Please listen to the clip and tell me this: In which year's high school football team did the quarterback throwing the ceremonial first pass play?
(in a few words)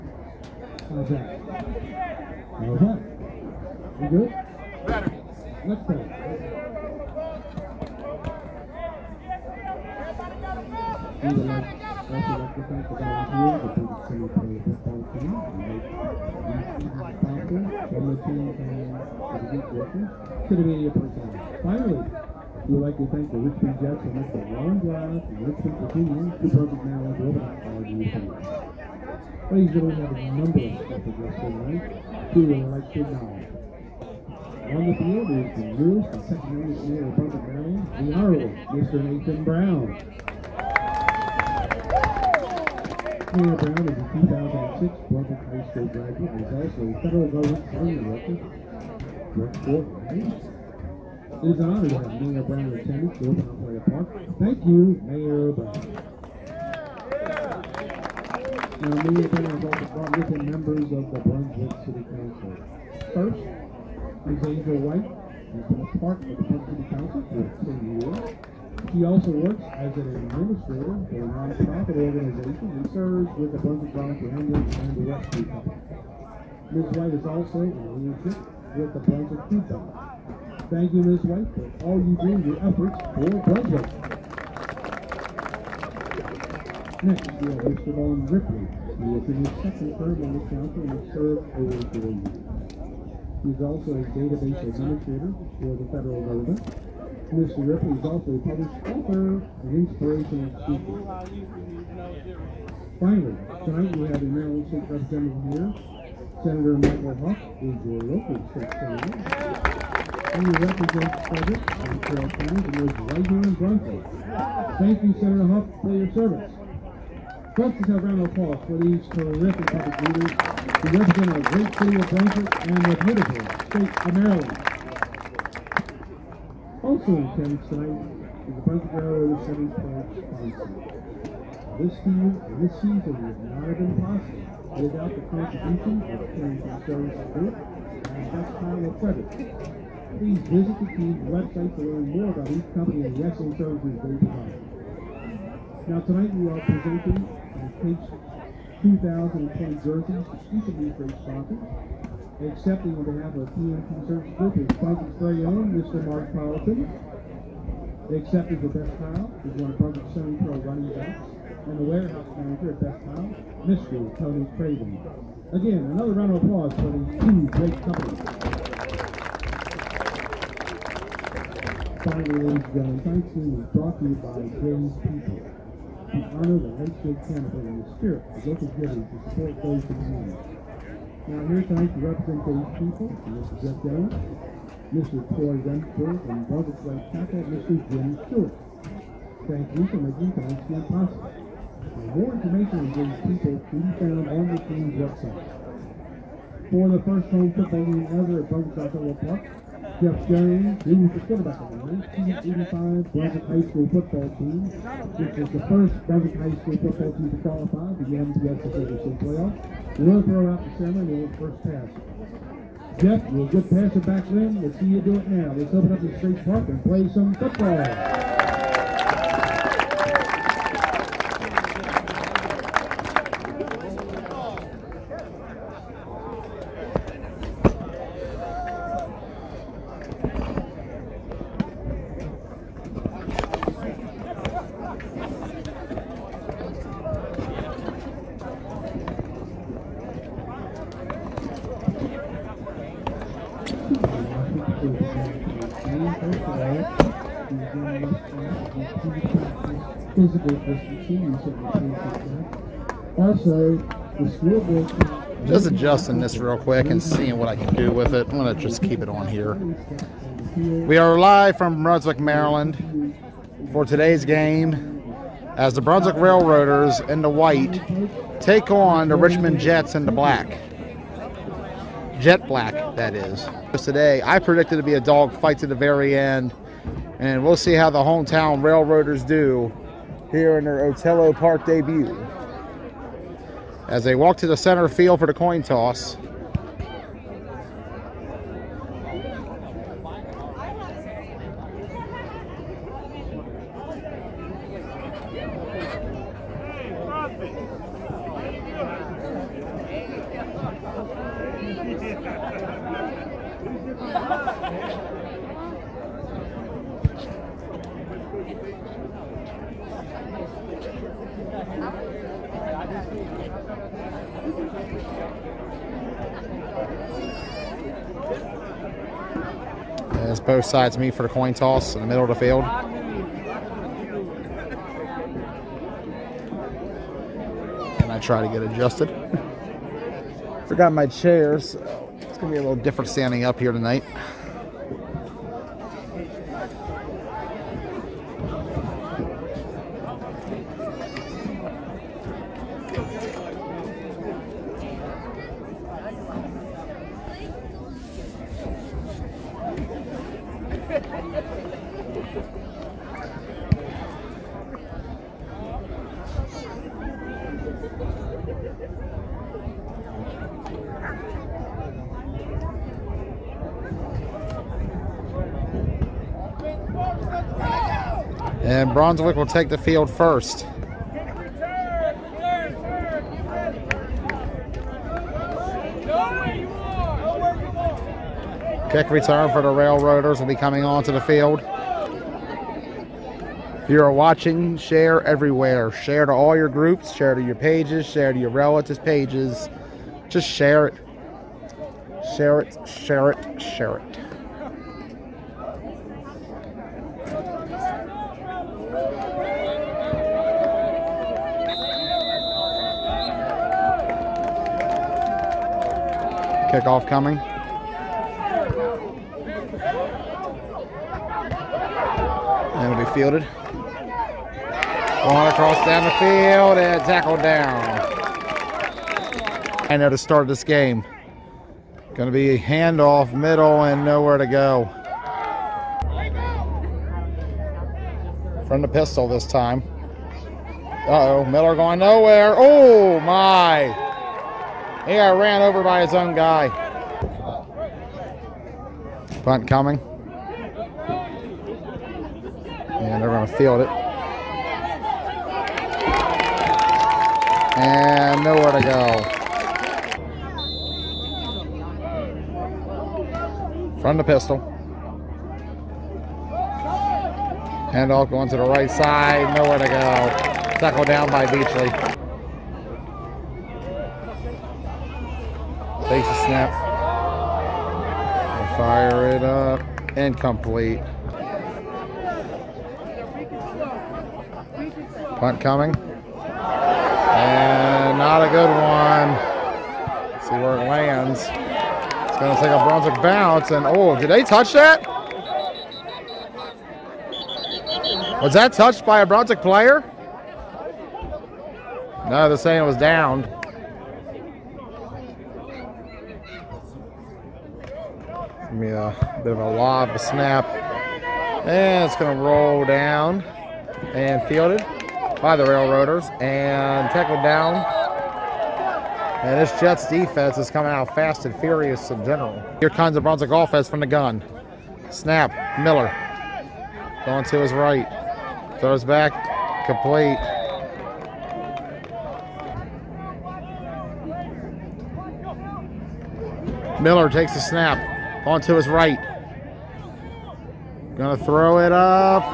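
1985.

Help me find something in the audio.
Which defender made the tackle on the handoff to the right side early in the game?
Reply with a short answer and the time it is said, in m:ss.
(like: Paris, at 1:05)
Beachley, at 7:41.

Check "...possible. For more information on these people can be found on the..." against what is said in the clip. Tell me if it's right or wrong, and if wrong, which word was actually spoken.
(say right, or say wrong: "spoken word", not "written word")
right.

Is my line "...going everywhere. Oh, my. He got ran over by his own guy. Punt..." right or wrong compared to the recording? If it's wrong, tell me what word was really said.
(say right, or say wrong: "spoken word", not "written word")
wrong: "nowhere", not "everywhere".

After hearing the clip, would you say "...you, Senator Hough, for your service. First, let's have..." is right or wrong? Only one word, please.
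right.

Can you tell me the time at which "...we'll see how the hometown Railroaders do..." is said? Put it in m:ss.
4:37.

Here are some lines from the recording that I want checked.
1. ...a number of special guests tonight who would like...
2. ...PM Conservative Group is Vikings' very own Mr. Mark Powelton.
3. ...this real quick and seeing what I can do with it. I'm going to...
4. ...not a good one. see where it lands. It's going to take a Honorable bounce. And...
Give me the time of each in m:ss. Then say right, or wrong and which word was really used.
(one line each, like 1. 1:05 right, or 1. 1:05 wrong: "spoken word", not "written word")
1. 0:30 right
2. 2:33 right
3. 4:16 right
4. 7:58 wrong: "Brunswick", not "Honorable".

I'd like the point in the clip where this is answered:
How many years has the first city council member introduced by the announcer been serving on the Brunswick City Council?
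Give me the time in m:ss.
1:07.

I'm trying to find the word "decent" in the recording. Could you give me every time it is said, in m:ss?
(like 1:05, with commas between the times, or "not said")
not said.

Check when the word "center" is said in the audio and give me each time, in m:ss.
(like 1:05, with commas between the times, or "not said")
3:30, 4:44.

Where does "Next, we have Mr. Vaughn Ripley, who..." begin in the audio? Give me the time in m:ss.
1:27.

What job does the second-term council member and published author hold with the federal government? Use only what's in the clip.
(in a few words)
Database administrator.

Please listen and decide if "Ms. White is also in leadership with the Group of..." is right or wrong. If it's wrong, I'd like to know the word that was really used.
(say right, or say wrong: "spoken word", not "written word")
wrong: "Brunswick", not "Group".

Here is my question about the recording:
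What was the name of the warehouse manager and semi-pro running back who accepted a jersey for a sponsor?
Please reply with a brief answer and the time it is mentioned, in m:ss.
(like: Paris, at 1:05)
Tony Craven, at 2:44.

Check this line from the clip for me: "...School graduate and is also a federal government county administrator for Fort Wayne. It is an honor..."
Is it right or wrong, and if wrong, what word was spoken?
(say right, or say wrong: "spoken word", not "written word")
wrong: "director", not "administrator".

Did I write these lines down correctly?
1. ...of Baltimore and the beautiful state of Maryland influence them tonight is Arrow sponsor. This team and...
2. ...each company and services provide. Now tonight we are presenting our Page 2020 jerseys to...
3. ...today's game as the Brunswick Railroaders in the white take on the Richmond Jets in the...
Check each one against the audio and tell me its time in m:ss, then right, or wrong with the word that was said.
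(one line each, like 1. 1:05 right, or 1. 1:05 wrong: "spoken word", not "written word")
1. 2:01 right
2. 2:22 right
3. 4:23 right.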